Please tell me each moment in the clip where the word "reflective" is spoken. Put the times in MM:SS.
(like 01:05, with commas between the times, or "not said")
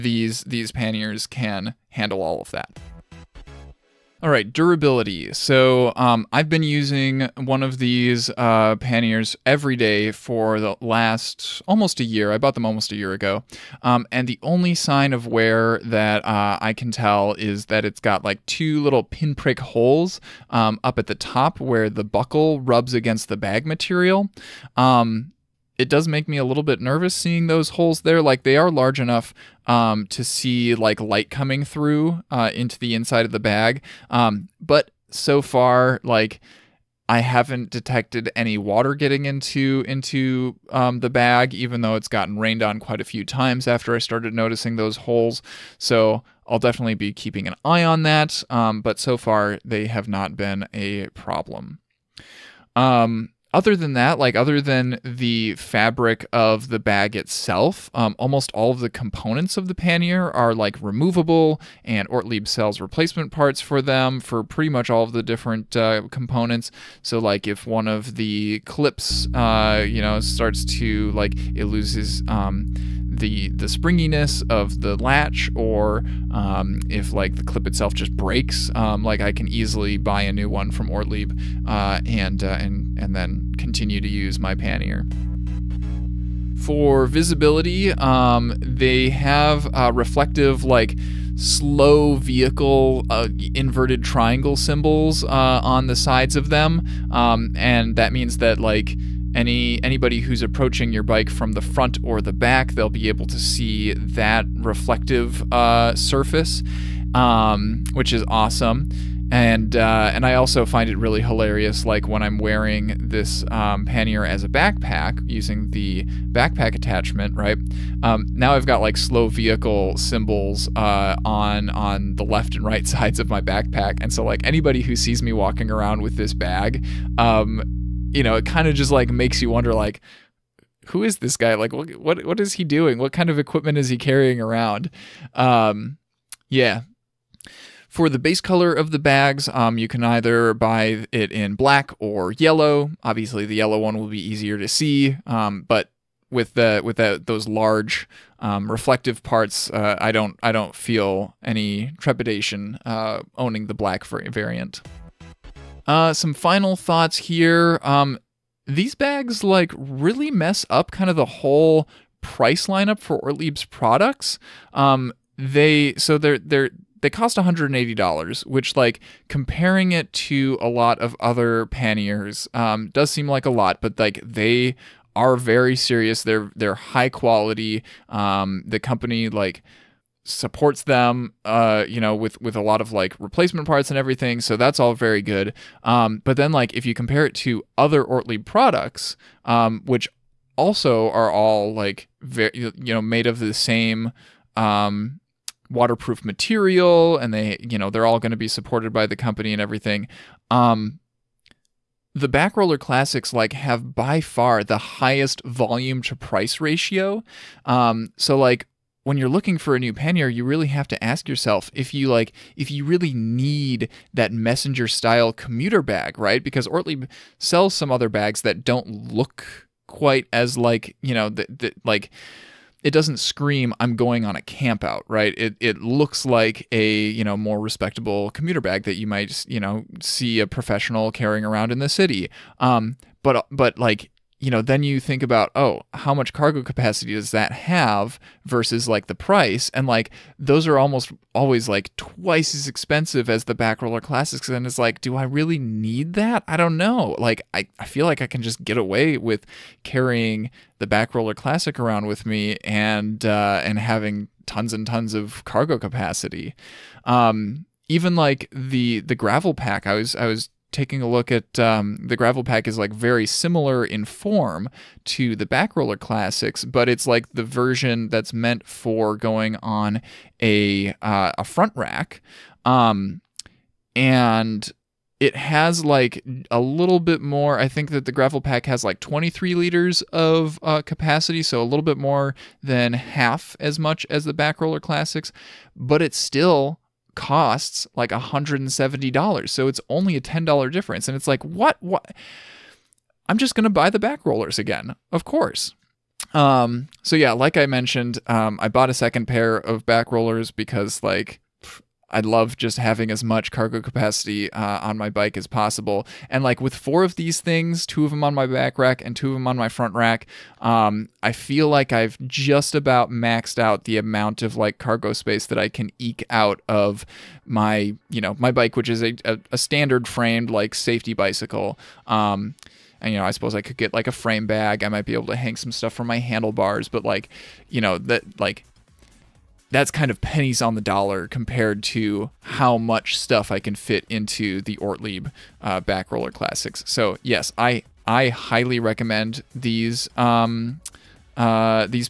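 01:29, 01:44, 02:28.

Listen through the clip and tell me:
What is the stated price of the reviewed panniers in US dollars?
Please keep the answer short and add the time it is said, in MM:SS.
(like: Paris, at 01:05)
$180, at 02:47.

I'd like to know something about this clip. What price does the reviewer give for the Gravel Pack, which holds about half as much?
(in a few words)
$170.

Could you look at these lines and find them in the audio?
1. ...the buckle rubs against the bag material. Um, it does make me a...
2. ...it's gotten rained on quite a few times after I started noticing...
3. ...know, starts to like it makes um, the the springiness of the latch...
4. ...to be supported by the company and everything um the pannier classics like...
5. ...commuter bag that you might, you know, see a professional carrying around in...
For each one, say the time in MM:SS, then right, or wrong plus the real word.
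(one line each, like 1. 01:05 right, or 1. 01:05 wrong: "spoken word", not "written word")
1. 00:21 right
2. 00:41 right
3. 01:10 wrong: "loses", not "makes"
4. 03:18 wrong: "backroller", not "pannier"
5. 03:48 right.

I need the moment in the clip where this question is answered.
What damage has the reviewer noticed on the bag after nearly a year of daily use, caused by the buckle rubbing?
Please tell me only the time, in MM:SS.
00:18.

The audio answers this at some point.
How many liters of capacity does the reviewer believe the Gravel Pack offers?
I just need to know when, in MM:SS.
04:38.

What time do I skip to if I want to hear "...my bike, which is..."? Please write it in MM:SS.
05:18.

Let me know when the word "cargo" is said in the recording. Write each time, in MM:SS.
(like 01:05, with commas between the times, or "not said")
03:56, 04:15, 05:03, 05:14.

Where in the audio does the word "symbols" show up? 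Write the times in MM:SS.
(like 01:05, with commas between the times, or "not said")
01:34, 01:59.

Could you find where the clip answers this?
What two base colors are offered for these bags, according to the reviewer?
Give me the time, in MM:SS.
02:21.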